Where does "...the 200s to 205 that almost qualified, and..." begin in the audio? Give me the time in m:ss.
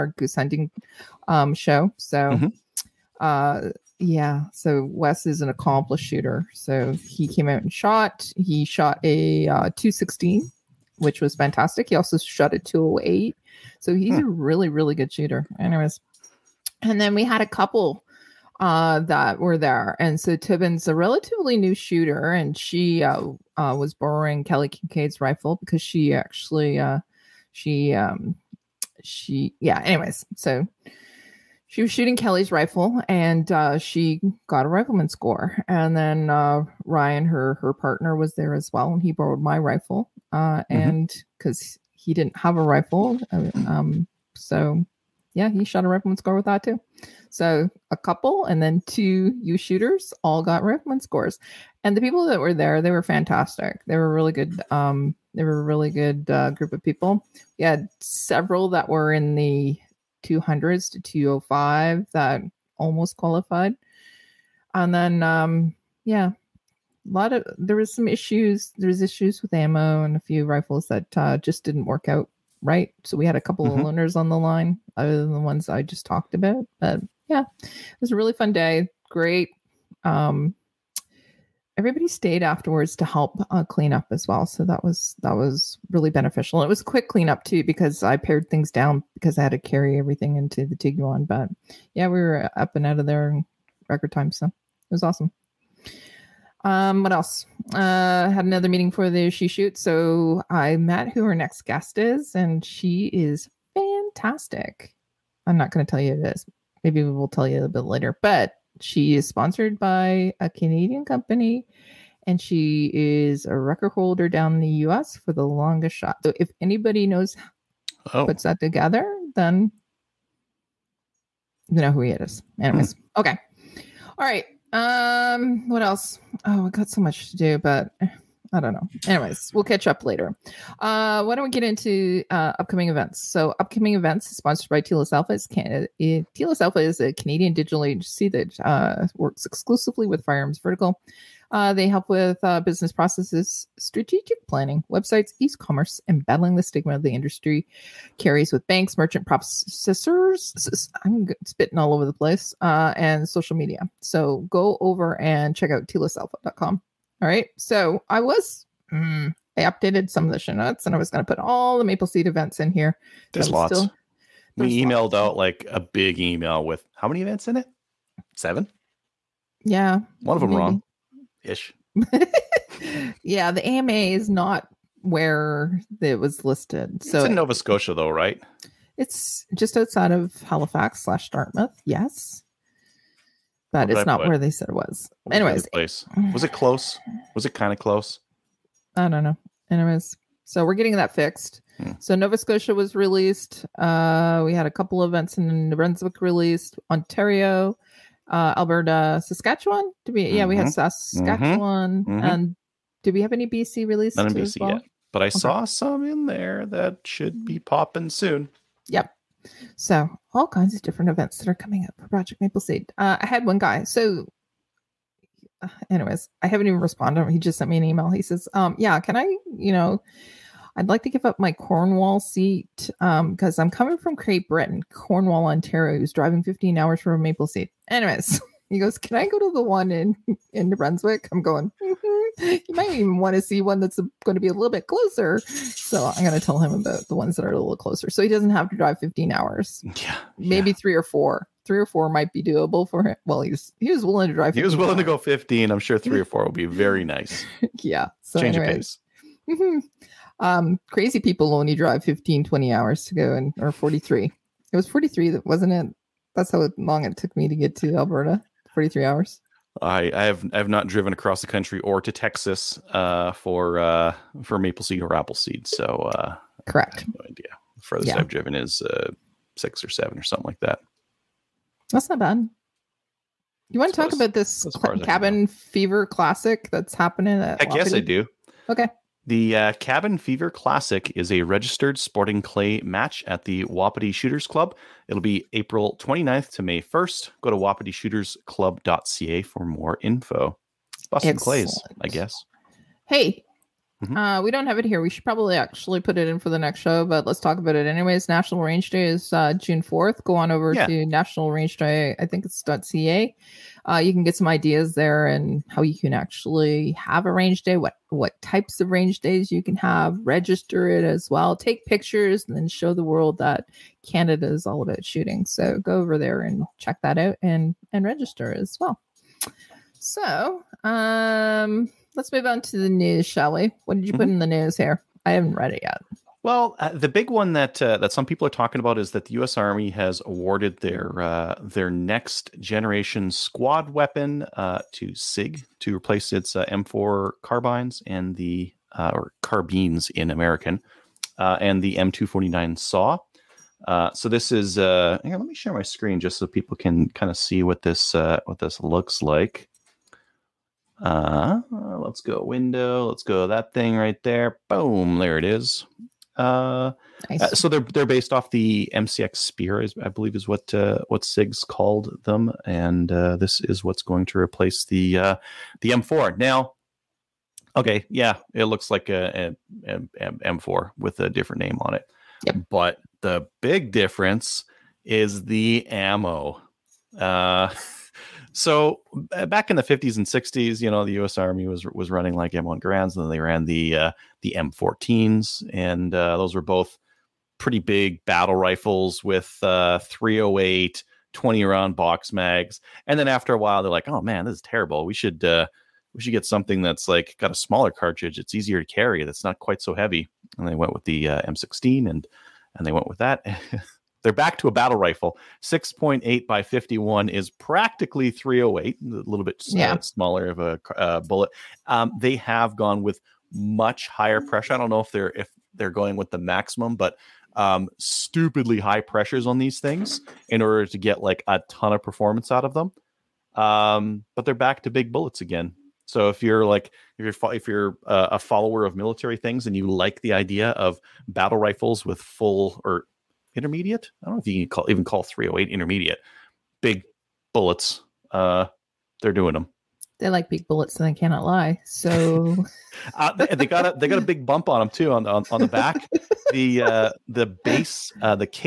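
0:59.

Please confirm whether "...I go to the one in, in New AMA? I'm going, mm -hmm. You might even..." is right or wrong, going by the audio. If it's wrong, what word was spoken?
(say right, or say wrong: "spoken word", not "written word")
wrong: "Brunswick", not "AMA".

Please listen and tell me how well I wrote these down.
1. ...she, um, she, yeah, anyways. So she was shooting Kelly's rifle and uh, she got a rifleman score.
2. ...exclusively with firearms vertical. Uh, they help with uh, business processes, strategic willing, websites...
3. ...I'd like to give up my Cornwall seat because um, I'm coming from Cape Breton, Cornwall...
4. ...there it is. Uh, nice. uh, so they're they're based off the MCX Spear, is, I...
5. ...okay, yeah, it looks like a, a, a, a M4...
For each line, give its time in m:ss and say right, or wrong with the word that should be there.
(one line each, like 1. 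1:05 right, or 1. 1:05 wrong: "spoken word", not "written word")
1. 0:27 right
2. 2:19 wrong: "planning", not "willing"
3. 3:40 right
4. 5:55 right
5. 6:07 right.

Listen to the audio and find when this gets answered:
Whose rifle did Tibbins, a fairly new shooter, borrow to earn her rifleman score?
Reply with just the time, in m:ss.
0:24.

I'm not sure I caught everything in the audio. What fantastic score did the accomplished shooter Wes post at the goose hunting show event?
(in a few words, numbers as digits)
216.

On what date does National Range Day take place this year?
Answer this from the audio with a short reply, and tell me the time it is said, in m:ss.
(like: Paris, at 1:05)
June 4th, at 4:59.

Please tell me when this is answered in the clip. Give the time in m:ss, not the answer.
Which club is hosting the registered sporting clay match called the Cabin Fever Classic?
4:43.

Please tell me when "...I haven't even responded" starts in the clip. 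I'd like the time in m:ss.
3:36.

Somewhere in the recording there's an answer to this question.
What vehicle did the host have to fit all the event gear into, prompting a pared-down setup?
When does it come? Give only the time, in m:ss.
1:30.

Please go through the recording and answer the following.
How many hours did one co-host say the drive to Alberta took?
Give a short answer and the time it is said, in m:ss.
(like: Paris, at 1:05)
43, at 4:18.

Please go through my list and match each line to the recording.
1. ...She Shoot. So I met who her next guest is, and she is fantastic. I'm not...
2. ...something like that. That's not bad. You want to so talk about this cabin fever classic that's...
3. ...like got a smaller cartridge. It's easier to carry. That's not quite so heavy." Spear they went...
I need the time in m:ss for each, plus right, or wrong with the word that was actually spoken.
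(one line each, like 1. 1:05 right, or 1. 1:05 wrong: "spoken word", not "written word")
1. 1:39 right
2. 4:30 right
3. 6:37 wrong: "And", not "Spear".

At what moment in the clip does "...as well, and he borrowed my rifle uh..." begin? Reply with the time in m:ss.
0:38.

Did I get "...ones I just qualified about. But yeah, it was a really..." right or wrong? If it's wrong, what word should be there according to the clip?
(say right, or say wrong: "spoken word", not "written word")
wrong: "talked", not "qualified".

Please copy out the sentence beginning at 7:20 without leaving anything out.
They like big bullets, and they cannot lie.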